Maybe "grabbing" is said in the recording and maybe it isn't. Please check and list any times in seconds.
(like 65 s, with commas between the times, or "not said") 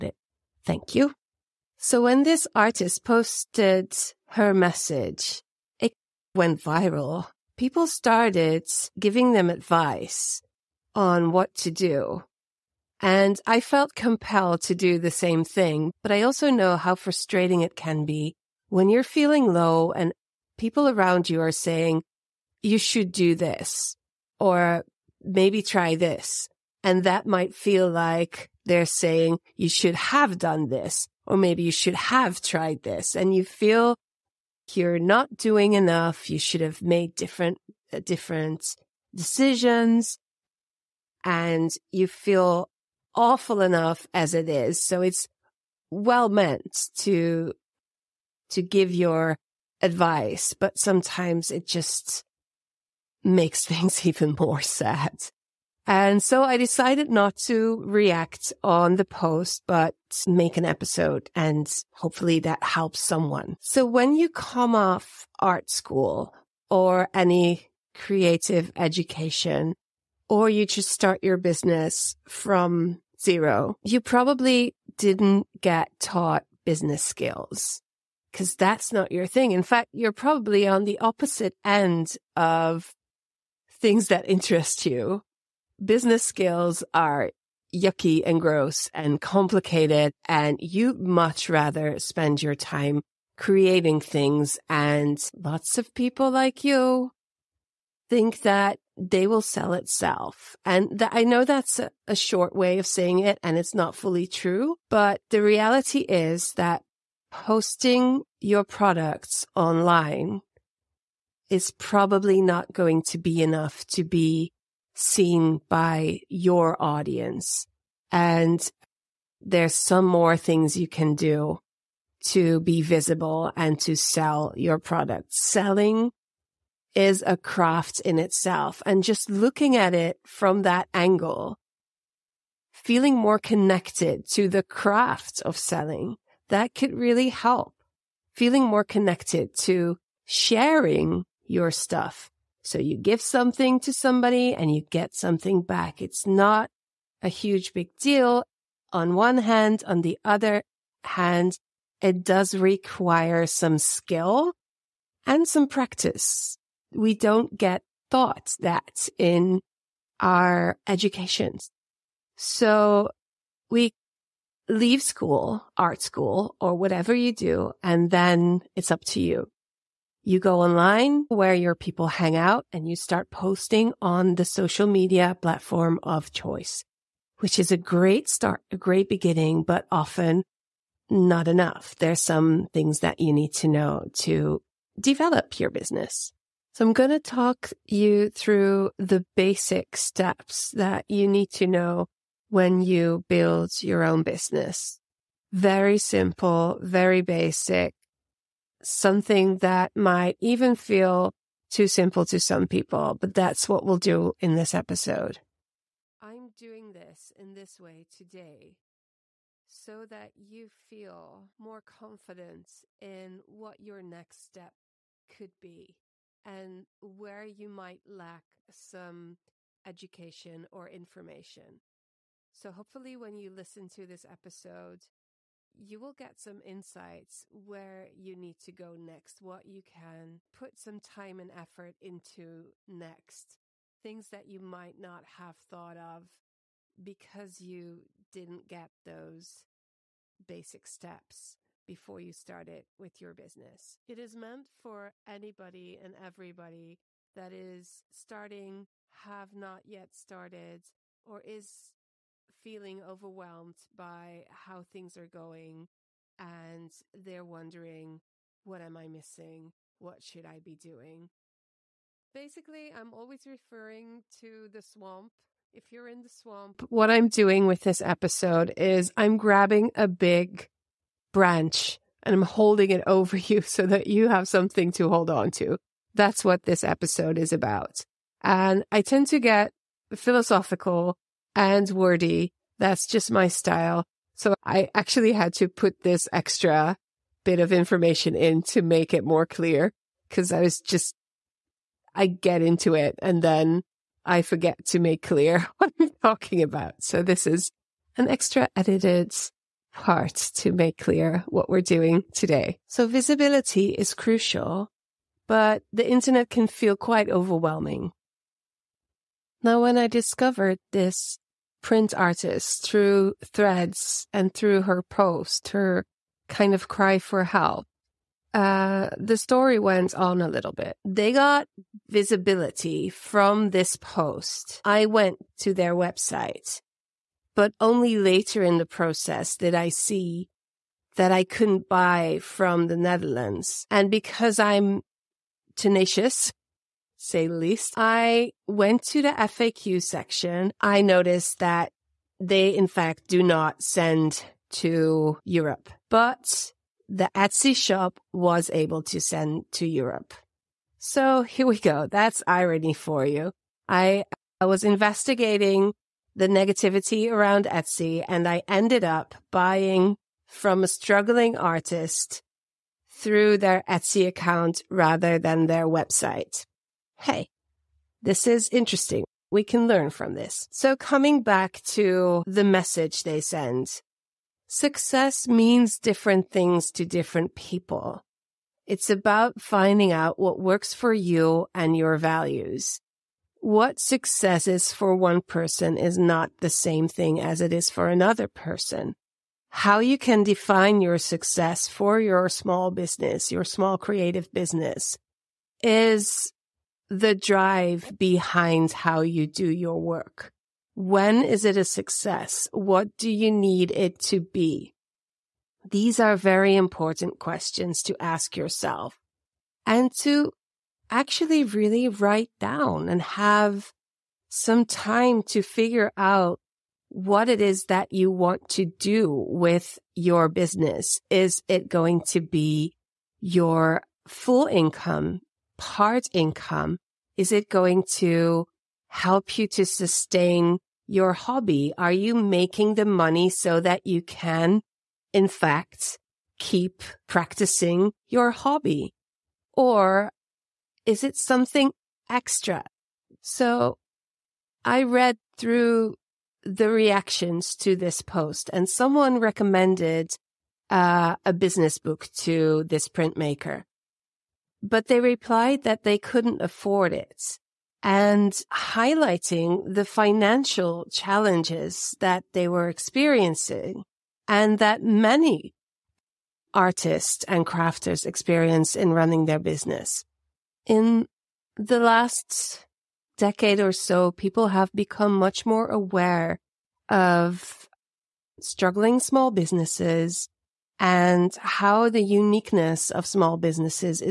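269 s.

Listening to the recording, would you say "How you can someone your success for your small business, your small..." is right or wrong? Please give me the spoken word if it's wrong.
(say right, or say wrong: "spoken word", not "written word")
wrong: "define", not "someone".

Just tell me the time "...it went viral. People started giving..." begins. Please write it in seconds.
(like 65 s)
5 s.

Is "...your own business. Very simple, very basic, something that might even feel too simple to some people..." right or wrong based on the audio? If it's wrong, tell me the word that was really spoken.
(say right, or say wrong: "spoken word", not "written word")
right.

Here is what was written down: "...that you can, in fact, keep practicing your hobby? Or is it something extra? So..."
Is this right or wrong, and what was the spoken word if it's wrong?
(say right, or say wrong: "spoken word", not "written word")
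right.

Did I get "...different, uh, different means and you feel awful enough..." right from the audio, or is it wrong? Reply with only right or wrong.
wrong.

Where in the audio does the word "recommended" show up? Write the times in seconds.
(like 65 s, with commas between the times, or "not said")
449 s.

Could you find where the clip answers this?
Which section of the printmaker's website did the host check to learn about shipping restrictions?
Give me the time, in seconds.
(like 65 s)
339 s.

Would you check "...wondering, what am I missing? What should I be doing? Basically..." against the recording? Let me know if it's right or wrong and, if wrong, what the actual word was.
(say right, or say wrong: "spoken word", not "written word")
right.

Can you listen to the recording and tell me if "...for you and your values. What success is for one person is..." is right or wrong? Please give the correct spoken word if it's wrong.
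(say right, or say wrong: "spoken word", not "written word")
right.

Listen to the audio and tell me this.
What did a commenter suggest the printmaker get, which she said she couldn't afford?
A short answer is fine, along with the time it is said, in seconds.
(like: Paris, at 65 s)
a business book, at 451 s.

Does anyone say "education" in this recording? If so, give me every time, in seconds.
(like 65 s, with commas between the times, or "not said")
68 s, 160 s, 219 s.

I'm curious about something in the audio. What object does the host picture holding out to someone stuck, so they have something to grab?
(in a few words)
a big branch.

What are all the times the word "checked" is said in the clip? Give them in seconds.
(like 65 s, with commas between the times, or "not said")
not said.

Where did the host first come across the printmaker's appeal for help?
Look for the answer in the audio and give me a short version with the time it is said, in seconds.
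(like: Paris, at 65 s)
Threads, at 313 s.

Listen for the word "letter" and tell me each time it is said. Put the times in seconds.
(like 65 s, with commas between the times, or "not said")
not said.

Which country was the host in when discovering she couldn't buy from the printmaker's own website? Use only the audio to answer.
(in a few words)
the Netherlands.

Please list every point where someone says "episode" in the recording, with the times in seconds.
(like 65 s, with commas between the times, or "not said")
60 s, 204 s, 224 s, 268 s, 276 s.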